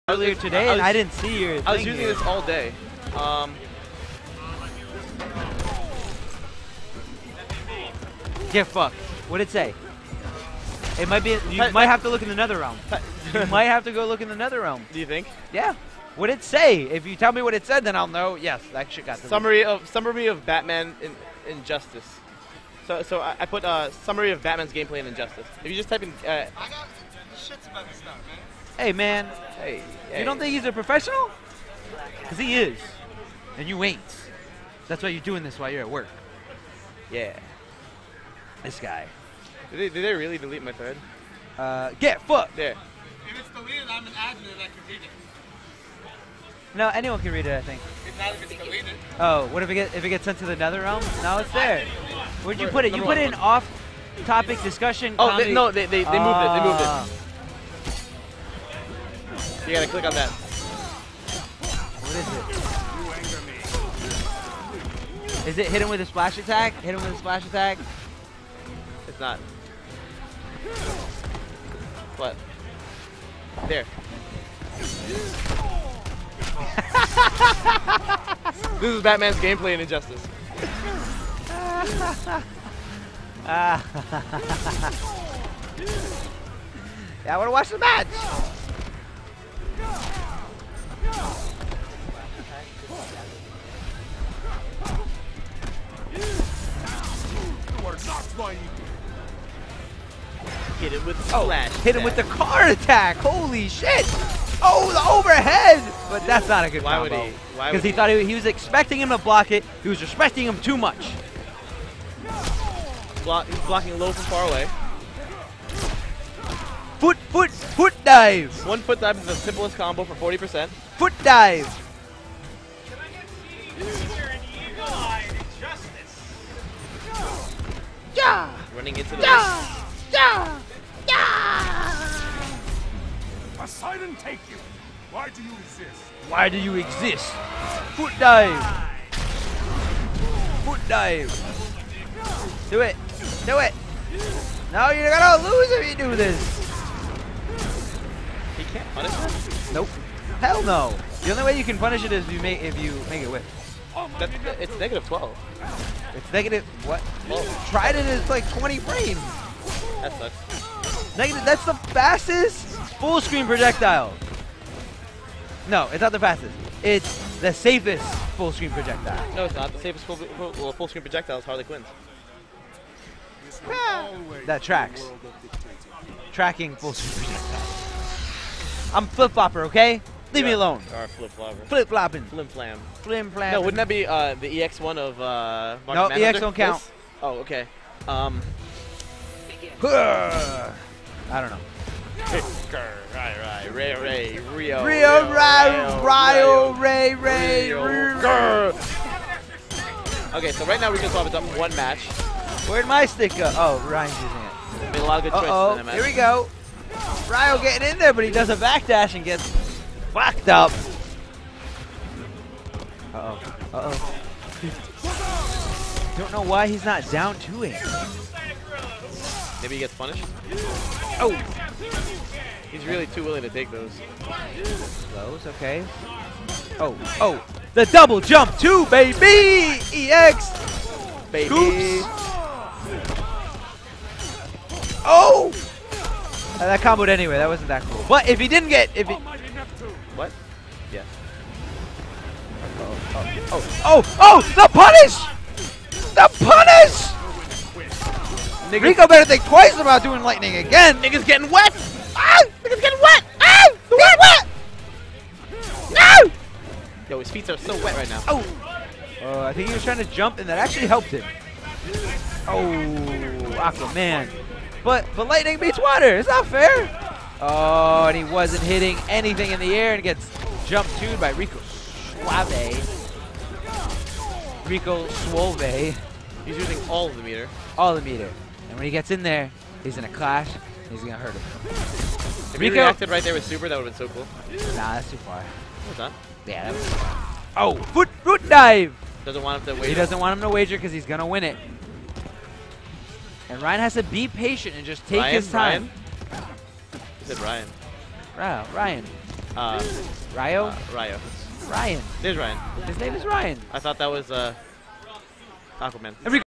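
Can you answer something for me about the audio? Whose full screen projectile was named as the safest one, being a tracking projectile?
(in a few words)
Harley Quinn's.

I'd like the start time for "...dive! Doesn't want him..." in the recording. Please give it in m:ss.
4:48.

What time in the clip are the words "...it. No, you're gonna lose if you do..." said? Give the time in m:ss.
2:23.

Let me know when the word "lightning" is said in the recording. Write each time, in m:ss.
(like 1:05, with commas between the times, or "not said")
4:10, 4:25.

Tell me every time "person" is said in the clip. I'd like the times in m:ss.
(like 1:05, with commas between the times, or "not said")
not said.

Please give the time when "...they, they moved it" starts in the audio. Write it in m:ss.
0:55.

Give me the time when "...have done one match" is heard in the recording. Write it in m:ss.
3:21.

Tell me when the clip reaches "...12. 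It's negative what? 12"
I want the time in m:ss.
2:35.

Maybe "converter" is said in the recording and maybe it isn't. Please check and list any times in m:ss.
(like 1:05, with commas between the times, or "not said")
not said.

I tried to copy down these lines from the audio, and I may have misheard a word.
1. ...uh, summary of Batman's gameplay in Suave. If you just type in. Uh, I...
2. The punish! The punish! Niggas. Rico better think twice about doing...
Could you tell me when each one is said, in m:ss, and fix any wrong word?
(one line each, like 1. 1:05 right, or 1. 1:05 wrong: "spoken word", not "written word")
1. 0:23 wrong: "Injustice", not "Suave"
2. 4:04 right.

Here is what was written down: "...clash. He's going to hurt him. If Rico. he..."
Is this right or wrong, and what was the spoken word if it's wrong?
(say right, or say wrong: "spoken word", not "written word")
right.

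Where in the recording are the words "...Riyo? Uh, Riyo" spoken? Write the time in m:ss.
5:00.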